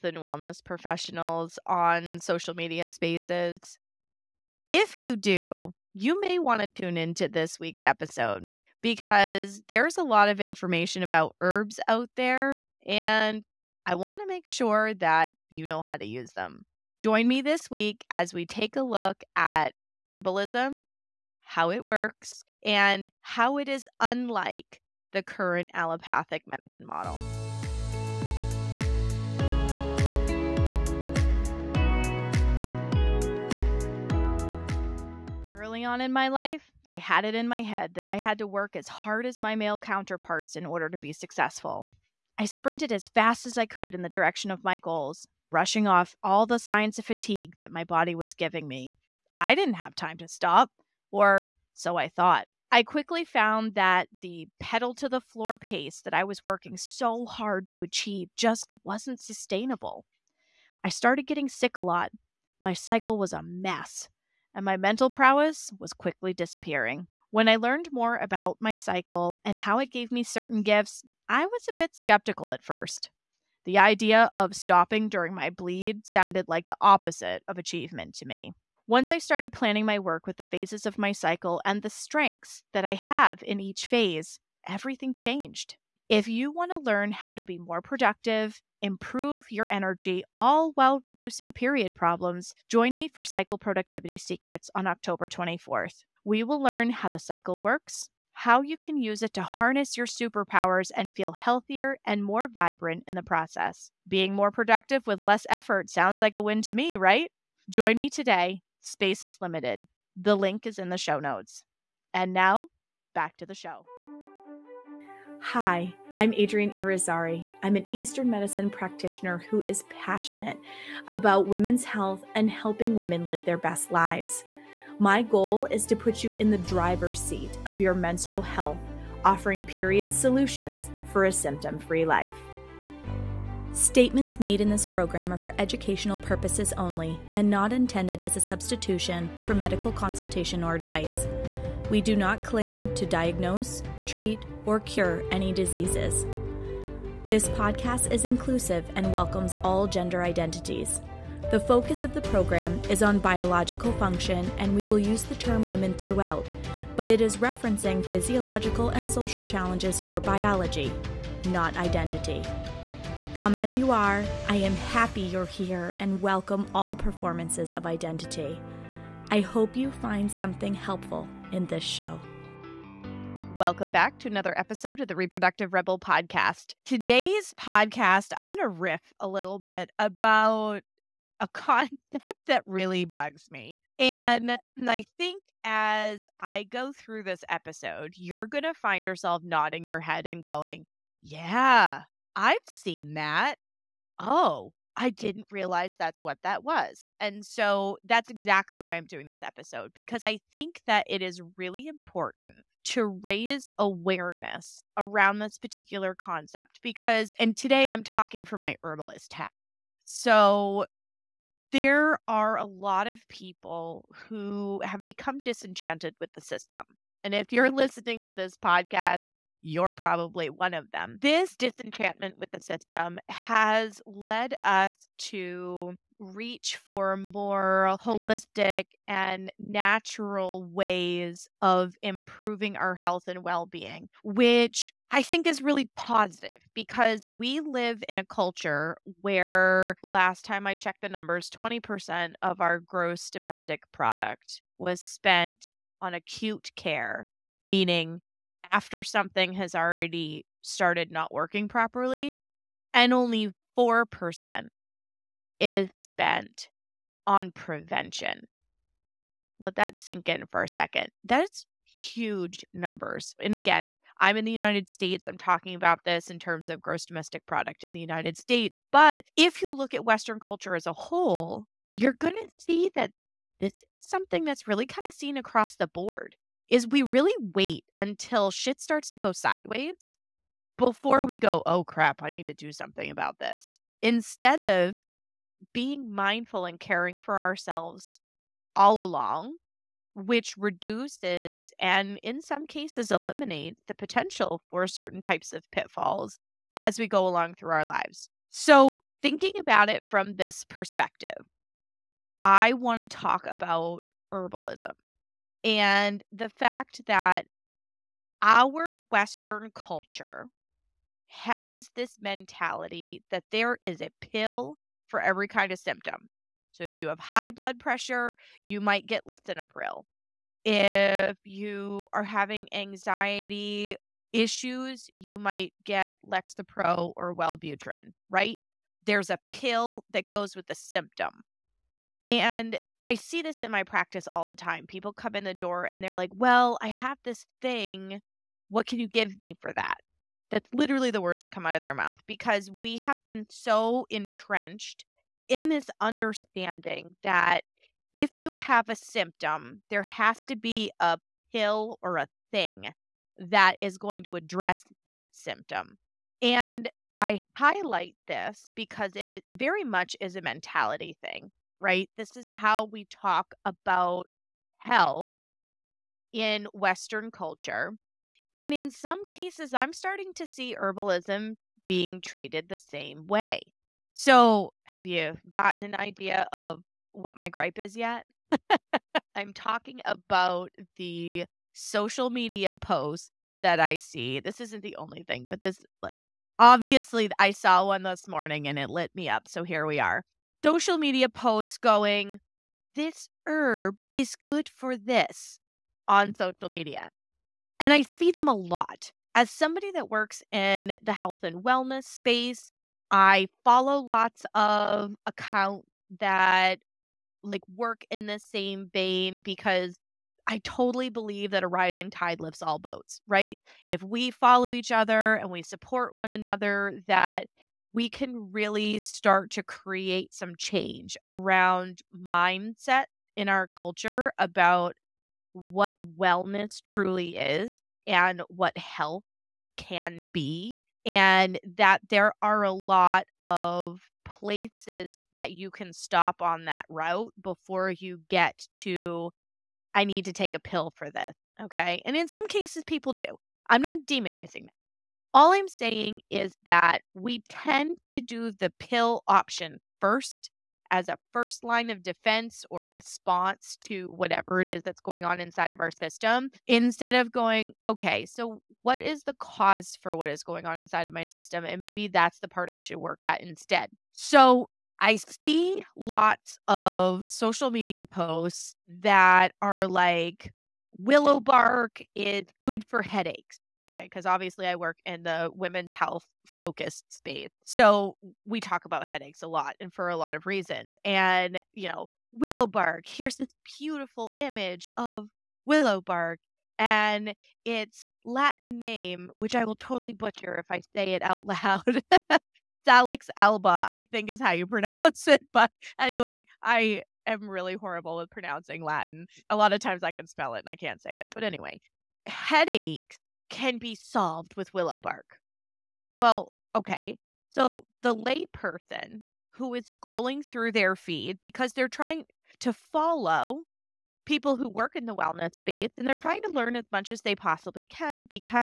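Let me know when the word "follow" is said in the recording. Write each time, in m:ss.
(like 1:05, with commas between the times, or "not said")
6:43, 6:54, 8:32.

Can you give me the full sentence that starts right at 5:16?
So if you have high blood pressure, you might get lisinopril.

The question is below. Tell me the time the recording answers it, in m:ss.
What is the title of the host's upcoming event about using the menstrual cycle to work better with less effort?
1:33.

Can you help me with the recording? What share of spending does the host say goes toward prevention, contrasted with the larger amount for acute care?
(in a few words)
4%.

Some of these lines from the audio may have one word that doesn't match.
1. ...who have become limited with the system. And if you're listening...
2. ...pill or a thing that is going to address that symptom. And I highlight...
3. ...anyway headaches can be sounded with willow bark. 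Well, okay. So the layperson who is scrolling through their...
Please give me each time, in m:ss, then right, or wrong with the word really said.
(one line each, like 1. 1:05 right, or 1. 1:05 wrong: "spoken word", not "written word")
1. 3:34 wrong: "disenchanted", not "limited"
2. 5:51 right
3. 8:21 wrong: "solved", not "sounded".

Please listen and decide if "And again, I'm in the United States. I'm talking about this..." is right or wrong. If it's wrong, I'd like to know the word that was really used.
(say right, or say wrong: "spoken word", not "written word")
right.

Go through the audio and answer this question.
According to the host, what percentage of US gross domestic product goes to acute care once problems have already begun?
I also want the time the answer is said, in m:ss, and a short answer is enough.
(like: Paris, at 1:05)
20%, at 4:01.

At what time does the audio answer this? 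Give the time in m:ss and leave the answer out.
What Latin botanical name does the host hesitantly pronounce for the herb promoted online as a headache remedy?
8:12.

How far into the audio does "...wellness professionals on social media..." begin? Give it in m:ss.
0:00.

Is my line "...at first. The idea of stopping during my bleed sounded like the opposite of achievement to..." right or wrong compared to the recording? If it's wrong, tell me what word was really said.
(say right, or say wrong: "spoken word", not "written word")
right.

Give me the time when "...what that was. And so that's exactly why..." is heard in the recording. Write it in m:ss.
3:16.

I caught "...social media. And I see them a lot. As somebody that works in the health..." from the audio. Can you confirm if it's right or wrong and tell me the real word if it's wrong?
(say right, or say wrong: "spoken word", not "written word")
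right.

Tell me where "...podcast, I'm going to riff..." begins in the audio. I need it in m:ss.
2:57.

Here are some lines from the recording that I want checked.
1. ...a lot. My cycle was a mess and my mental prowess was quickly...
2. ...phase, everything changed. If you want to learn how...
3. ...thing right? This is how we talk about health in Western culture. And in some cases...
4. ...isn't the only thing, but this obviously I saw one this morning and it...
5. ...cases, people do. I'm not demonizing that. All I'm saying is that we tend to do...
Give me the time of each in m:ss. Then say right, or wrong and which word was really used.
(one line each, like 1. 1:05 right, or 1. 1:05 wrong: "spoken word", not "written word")
1. 1:01 right
2. 1:23 right
3. 6:01 right
4. 6:24 right
5. 7:22 right.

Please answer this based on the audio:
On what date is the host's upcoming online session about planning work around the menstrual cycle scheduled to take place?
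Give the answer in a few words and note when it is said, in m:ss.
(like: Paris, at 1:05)
October 24th, at 1:34.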